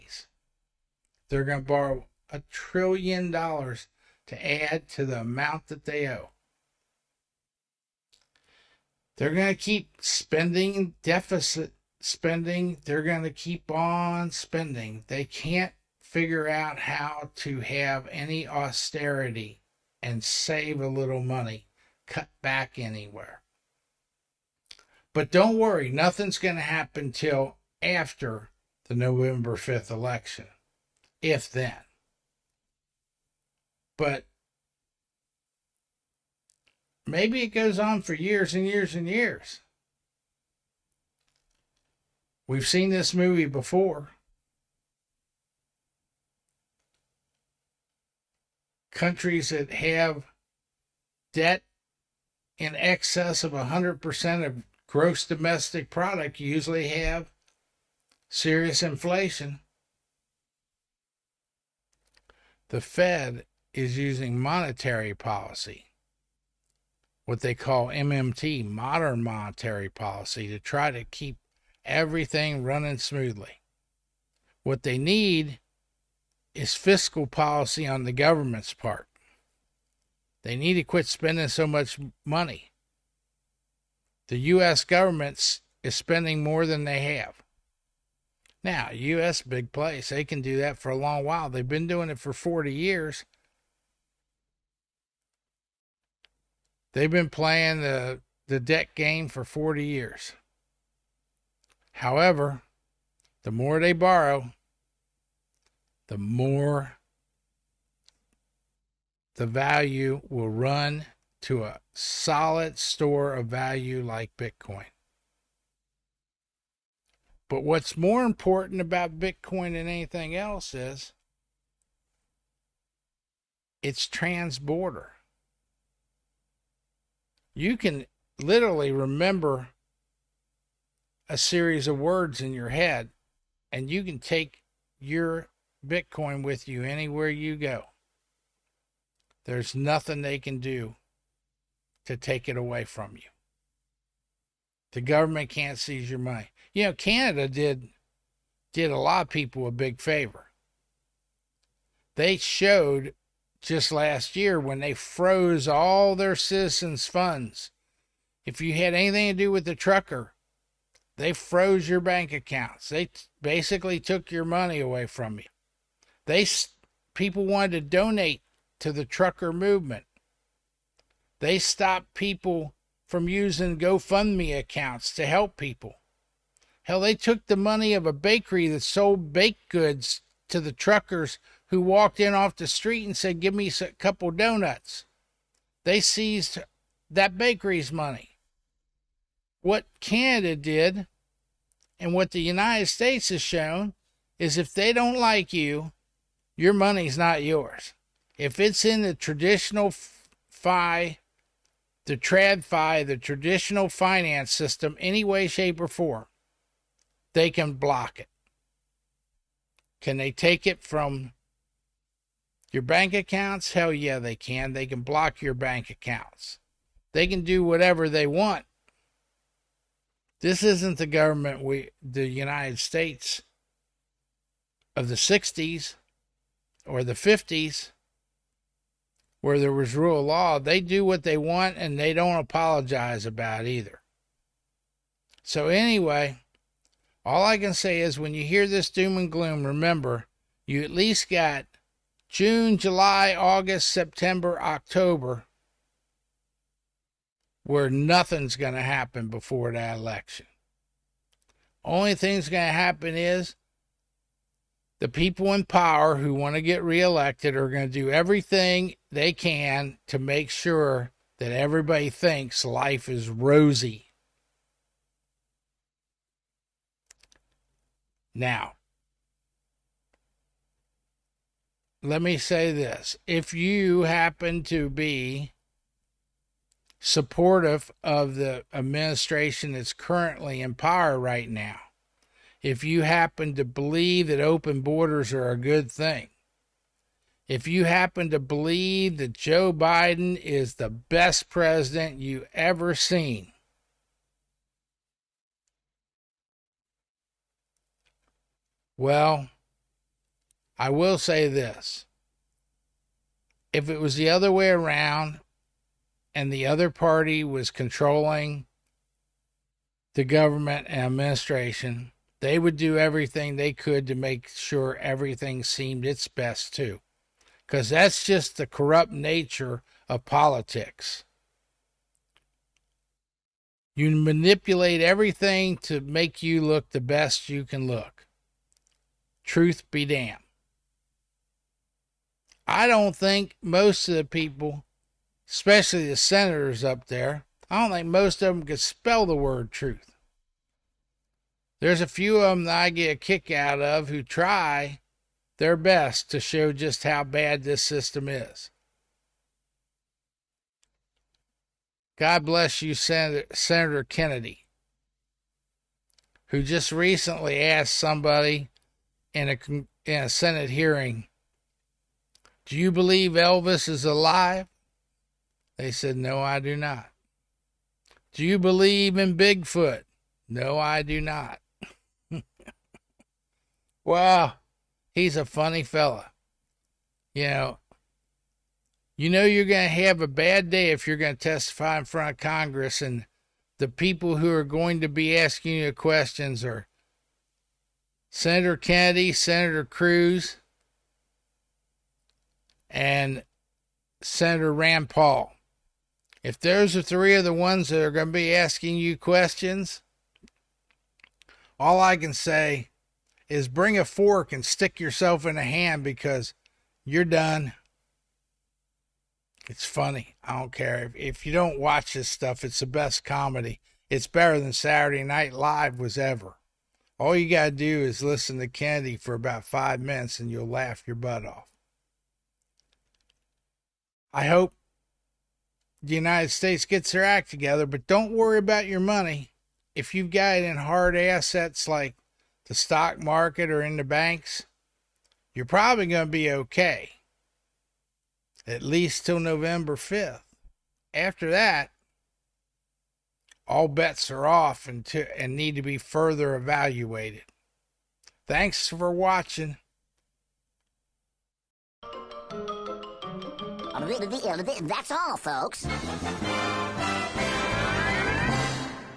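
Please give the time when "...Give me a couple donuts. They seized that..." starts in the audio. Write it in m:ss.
3:03.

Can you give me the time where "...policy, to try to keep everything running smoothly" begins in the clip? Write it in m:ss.
1:09.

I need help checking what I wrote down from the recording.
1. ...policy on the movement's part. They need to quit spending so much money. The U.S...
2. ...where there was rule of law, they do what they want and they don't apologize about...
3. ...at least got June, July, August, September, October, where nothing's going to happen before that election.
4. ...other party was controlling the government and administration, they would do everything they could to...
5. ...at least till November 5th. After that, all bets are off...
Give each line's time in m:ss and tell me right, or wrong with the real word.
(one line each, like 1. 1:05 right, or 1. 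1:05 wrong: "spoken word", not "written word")
1. 1:17 wrong: "government", not "movement"
2. 3:49 right
3. 4:00 right
4. 5:06 right
5. 7:18 right.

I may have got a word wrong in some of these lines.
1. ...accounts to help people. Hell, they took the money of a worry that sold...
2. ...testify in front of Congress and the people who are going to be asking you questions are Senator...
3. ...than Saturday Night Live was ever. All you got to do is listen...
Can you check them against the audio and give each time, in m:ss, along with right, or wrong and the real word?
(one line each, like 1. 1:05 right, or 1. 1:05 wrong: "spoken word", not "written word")
1. 2:54 wrong: "bakery", not "worry"
2. 6:21 right
3. 6:54 right.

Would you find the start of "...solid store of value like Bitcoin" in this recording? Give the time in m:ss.
1:51.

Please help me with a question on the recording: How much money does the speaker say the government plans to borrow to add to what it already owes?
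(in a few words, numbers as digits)
a trillion dollars.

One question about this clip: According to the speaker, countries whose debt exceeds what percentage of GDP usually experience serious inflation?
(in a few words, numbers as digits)
100%.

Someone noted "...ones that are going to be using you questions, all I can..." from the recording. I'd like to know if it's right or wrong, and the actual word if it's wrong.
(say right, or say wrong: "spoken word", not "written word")
wrong: "asking", not "using".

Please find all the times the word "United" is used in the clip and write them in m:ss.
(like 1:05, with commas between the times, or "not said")
3:12, 3:42, 7:06.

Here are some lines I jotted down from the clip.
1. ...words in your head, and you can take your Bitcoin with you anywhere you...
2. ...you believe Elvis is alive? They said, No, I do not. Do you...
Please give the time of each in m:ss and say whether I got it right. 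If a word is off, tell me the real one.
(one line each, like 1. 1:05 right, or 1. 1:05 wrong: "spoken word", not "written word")
1. 2:11 right
2. 6:02 right.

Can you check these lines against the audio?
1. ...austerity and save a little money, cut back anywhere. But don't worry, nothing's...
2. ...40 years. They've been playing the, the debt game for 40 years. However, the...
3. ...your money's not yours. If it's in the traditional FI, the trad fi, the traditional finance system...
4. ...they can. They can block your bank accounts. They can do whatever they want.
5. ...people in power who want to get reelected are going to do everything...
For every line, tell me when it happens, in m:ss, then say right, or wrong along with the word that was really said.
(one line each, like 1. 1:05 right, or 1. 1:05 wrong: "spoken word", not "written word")
1. 0:18 right
2. 1:32 right
3. 3:16 right
4. 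3:34 right
5. 4:15 right.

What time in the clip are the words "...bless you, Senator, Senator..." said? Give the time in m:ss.
5:52.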